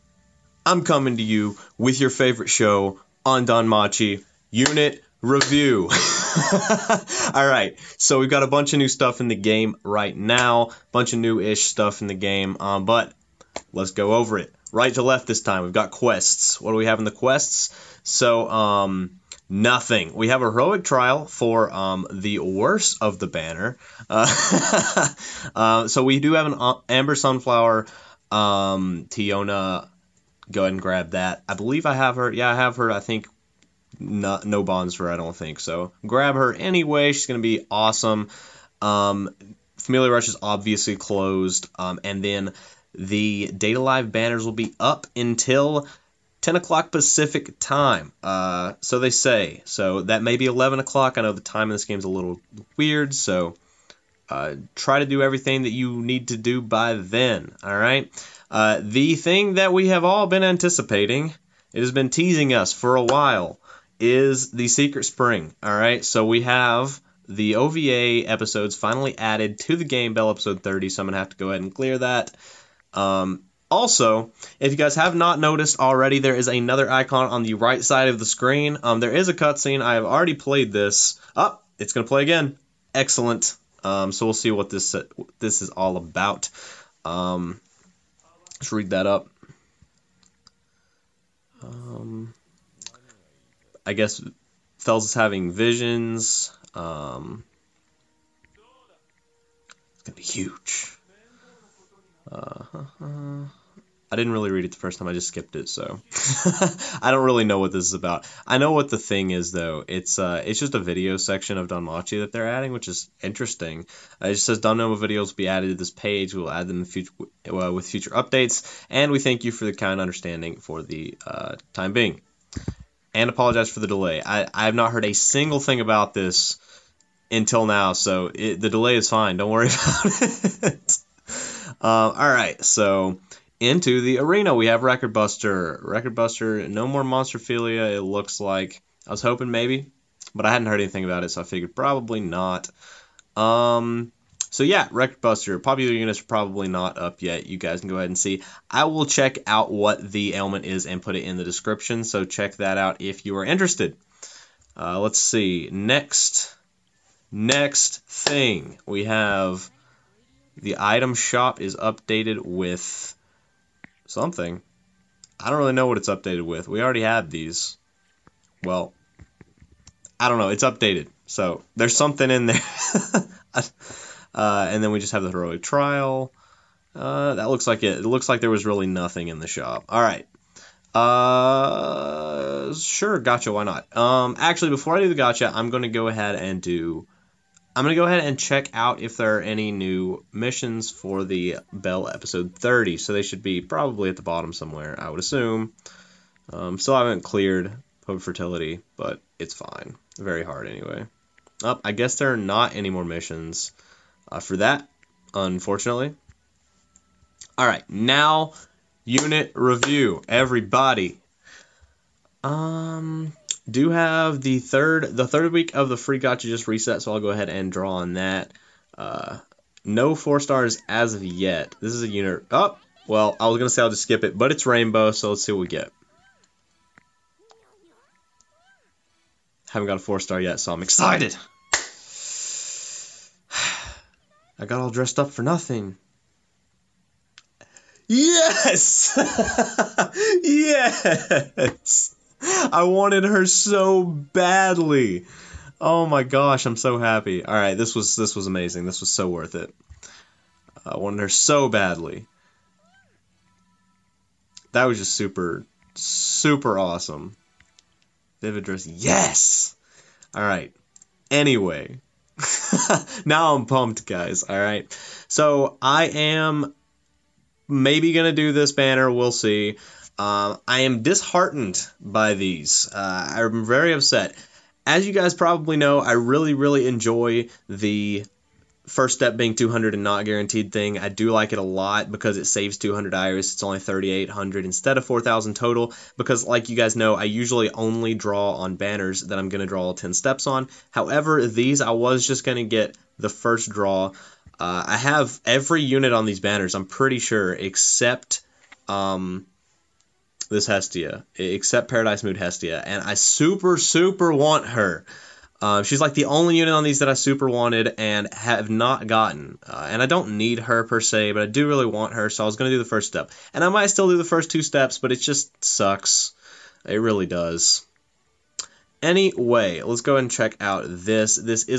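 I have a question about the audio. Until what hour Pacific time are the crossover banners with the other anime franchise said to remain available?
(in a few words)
10 o'clock.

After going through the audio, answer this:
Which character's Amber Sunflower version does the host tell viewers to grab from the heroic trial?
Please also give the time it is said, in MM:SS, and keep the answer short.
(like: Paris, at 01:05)
Tiona, at 00:29.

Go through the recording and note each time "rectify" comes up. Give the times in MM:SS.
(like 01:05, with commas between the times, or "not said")
not said.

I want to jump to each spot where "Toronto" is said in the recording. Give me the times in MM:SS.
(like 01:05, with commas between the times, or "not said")
not said.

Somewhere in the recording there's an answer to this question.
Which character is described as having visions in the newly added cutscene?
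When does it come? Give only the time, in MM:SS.
01:34.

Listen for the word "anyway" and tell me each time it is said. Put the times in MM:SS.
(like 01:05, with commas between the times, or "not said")
00:36, 03:20, 04:21, 05:19.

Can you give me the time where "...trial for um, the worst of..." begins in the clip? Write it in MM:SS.
00:20.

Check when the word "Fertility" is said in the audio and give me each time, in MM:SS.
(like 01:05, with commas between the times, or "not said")
03:18.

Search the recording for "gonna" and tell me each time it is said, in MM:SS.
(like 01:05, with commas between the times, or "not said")
01:40, 03:43, 04:28.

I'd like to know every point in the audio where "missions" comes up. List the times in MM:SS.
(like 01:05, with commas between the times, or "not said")
03:10, 03:23.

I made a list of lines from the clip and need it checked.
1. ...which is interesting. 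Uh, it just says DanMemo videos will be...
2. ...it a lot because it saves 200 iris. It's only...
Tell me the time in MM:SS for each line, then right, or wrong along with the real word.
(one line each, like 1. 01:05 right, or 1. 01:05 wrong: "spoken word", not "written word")
1. 01:52 right
2. 04:41 right.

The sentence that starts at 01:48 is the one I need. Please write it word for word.
I know what the thing is though.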